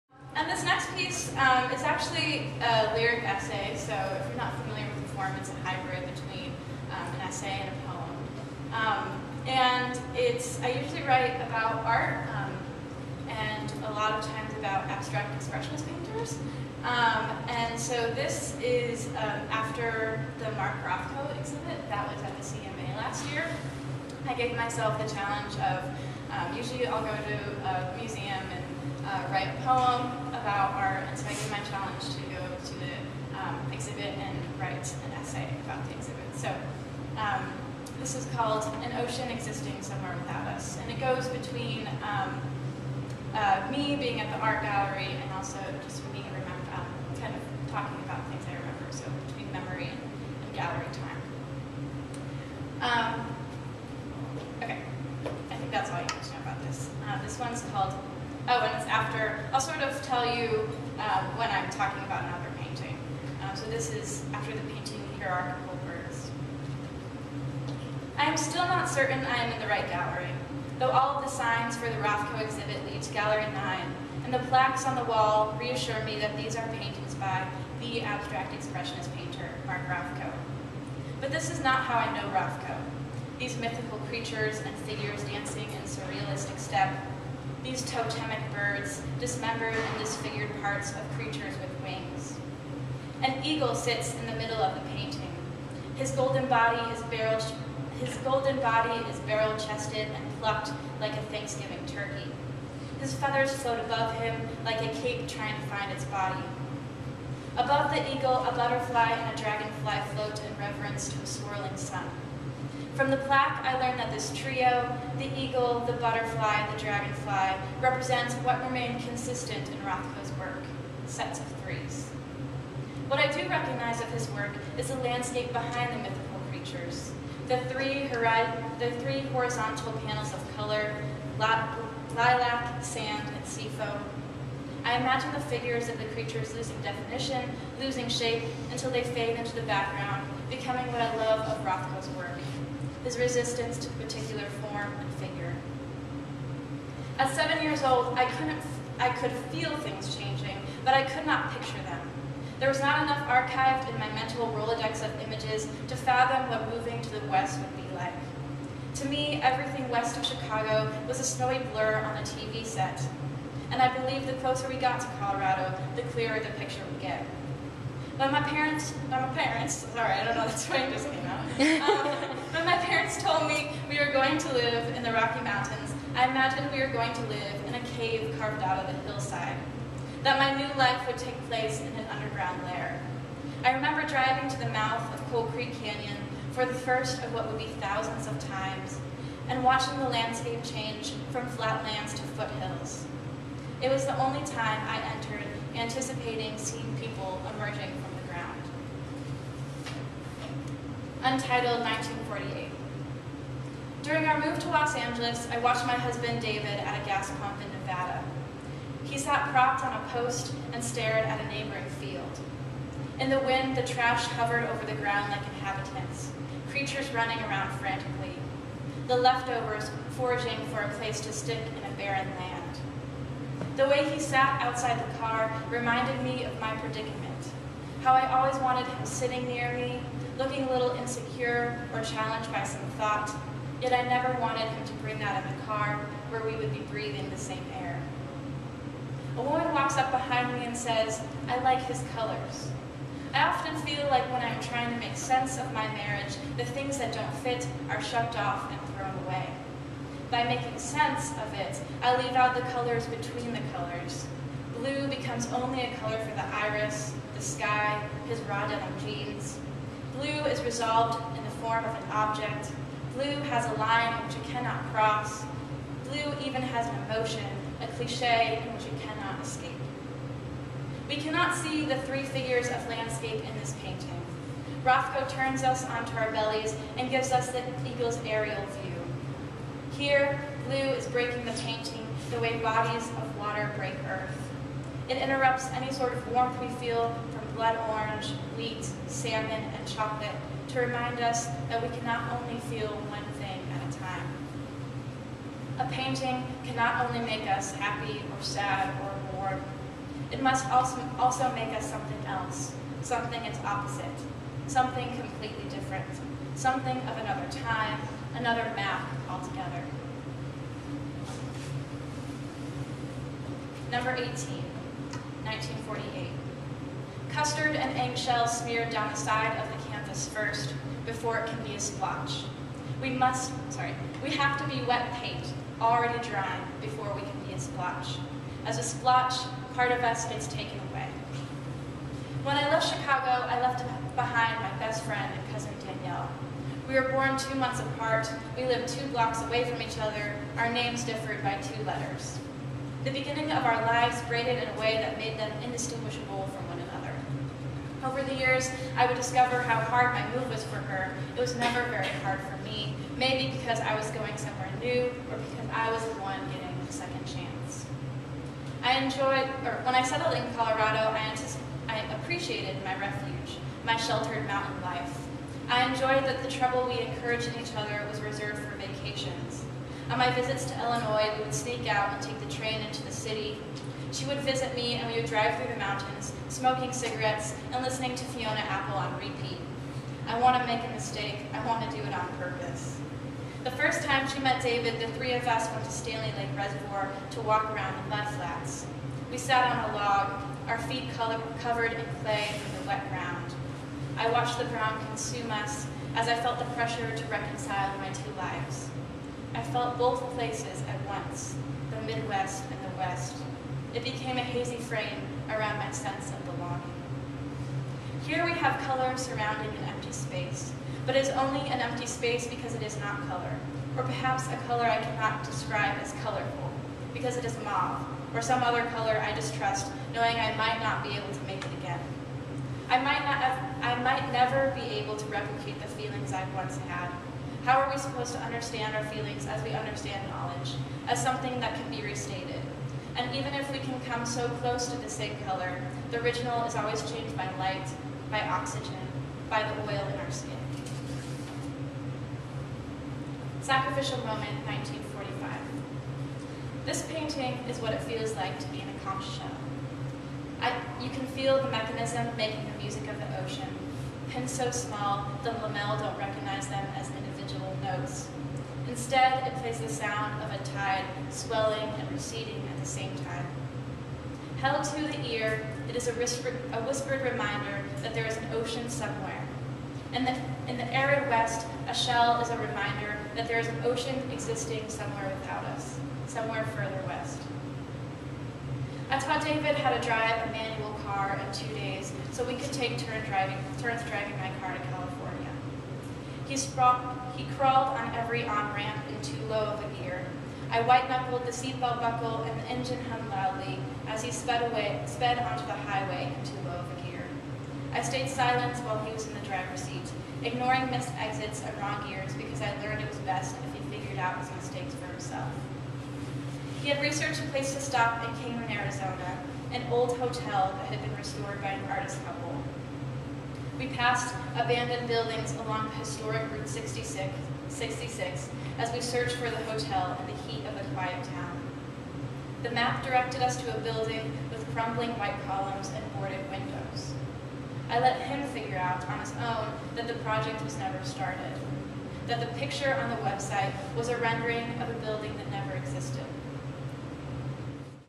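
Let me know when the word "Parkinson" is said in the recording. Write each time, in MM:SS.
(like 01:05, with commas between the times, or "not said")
not said.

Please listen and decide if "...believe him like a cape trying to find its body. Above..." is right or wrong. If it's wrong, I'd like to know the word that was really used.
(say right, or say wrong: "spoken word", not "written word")
wrong: "above", not "believe".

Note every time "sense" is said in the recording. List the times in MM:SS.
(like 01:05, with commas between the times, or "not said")
04:05, 04:10, 06:45.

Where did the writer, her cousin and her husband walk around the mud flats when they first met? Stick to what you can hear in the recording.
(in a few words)
Stanley Lake Reservoir.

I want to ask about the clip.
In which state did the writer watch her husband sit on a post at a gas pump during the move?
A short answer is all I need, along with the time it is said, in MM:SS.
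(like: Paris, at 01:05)
Nevada, at 03:27.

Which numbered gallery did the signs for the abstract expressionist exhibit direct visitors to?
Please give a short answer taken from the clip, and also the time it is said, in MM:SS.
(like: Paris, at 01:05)
Gallery 9, at 01:13.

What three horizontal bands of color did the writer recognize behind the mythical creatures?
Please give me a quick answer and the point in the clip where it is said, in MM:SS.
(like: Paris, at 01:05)
lilac, sand, and seafoam, at 02:11.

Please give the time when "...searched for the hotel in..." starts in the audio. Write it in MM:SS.
08:38.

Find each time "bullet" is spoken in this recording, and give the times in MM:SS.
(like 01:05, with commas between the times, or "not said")
not said.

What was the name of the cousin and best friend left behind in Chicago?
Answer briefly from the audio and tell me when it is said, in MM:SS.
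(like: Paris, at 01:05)
Danielle, at 05:35.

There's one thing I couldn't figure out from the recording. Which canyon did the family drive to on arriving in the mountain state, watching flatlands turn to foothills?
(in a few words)
Coal Creek Canyon.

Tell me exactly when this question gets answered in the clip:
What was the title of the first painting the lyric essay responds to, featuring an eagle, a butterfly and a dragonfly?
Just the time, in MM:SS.
01:05.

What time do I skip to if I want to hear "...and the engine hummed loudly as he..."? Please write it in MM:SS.
08:12.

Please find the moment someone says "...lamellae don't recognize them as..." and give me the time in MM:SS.
07:35.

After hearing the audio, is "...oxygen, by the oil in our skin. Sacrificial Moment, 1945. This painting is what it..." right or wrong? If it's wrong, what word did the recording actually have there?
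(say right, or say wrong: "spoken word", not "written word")
right.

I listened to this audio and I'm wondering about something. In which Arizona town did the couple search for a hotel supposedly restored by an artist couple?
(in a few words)
Kingman.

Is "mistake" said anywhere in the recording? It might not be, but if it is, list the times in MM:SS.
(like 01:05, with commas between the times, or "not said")
06:20, 08:24.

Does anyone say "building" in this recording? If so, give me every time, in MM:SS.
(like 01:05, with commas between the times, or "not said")
08:35, 08:43, 08:55.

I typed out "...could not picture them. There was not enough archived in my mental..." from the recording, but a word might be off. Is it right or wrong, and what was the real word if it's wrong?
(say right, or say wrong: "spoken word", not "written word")
right.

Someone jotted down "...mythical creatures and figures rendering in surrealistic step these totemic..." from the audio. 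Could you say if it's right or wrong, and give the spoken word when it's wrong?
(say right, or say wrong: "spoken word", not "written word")
wrong: "dancing", not "rendering".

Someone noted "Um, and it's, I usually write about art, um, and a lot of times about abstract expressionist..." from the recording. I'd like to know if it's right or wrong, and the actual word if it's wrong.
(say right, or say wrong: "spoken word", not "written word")
right.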